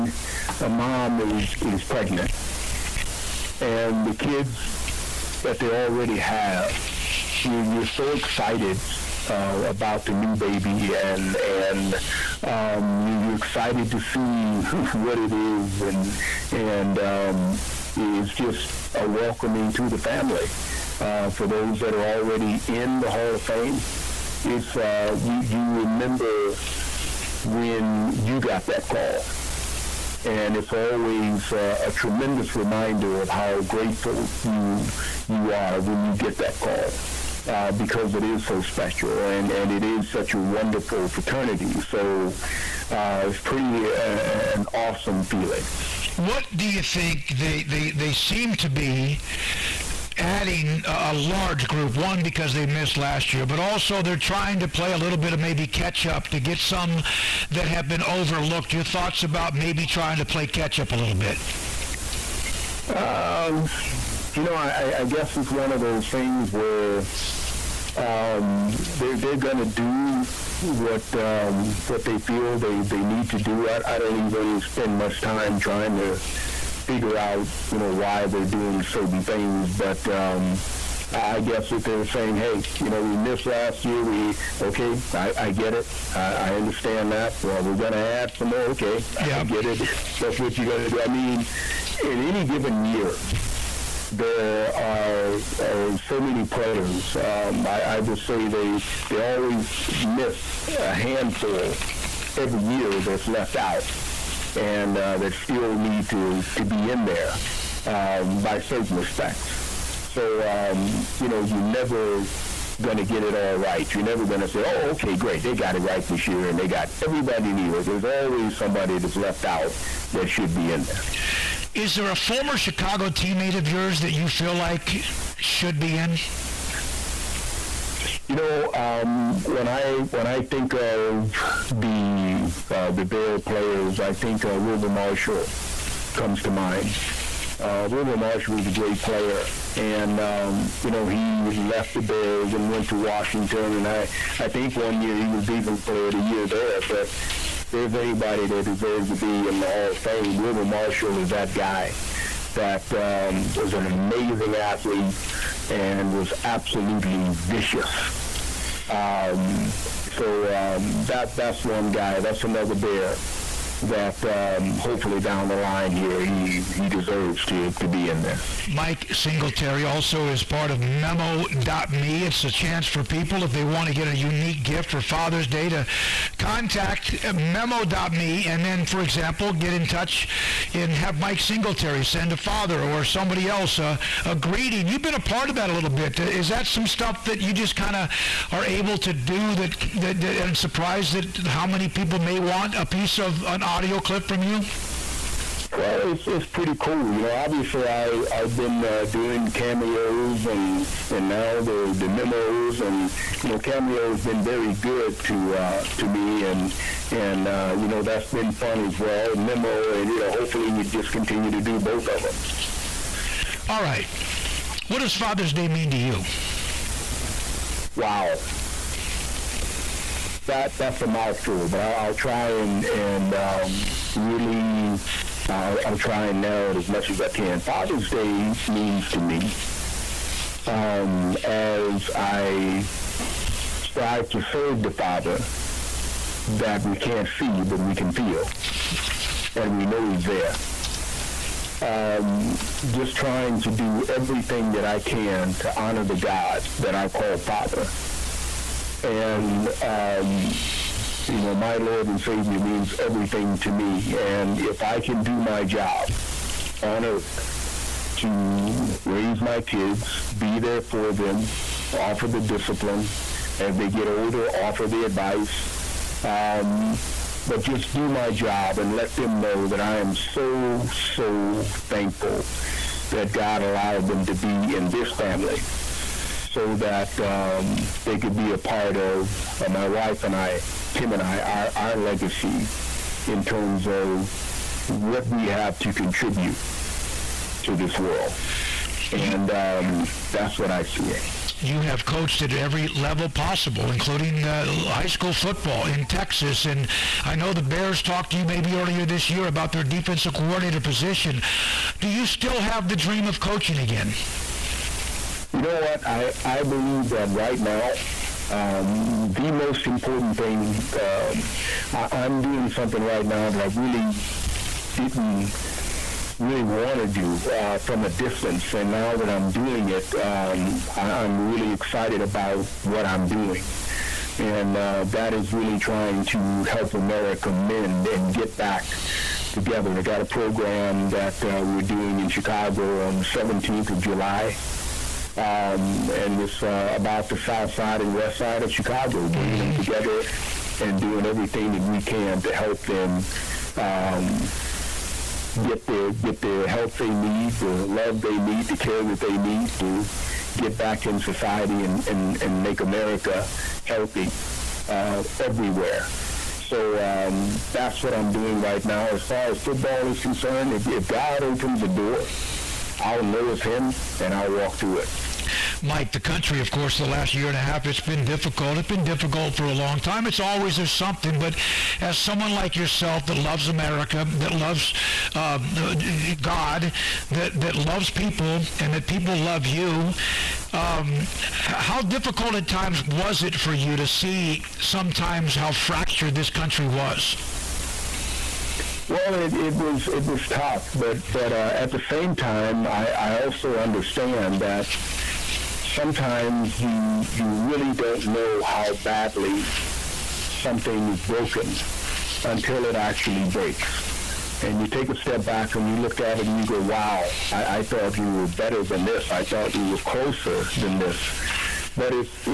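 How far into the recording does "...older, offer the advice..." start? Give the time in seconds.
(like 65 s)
264 s.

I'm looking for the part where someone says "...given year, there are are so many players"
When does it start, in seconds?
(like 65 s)
92 s.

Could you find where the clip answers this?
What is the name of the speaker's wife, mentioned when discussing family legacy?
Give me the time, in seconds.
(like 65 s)
280 s.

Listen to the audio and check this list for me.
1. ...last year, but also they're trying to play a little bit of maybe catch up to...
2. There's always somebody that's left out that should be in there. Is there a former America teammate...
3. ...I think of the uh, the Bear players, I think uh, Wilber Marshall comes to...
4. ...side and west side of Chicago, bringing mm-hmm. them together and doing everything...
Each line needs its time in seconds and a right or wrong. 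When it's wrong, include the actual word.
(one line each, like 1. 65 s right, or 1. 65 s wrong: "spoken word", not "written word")
1. 52 s right
2. 117 s wrong: "Chicago", not "America"
3. 130 s right
4. 337 s right.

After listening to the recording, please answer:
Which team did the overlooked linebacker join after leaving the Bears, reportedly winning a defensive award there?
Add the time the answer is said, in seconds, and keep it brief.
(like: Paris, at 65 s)
Washington, at 142 s.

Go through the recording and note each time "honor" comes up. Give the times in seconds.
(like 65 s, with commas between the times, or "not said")
245 s.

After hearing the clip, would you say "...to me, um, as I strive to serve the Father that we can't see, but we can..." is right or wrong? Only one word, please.
right.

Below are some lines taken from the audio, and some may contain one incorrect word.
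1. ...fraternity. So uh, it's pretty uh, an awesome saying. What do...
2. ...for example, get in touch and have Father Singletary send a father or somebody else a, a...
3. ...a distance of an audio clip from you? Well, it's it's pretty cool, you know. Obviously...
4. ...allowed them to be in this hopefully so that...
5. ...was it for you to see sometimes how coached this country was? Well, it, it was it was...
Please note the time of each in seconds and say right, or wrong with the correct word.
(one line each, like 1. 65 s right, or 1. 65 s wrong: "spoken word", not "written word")
1. 41 s wrong: "feeling", not "saying"
2. 178 s wrong: "Mike", not "Father"
3. 192 s wrong: "piece", not "distance"
4. 273 s wrong: "family", not "hopefully"
5. 383 s wrong: "fractured", not "coached".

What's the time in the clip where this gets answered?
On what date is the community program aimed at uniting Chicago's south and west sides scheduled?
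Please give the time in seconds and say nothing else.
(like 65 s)
333 s.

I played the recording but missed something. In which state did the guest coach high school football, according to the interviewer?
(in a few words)
Texas.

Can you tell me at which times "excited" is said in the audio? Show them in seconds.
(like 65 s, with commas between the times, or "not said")
8 s, 13 s, 321 s.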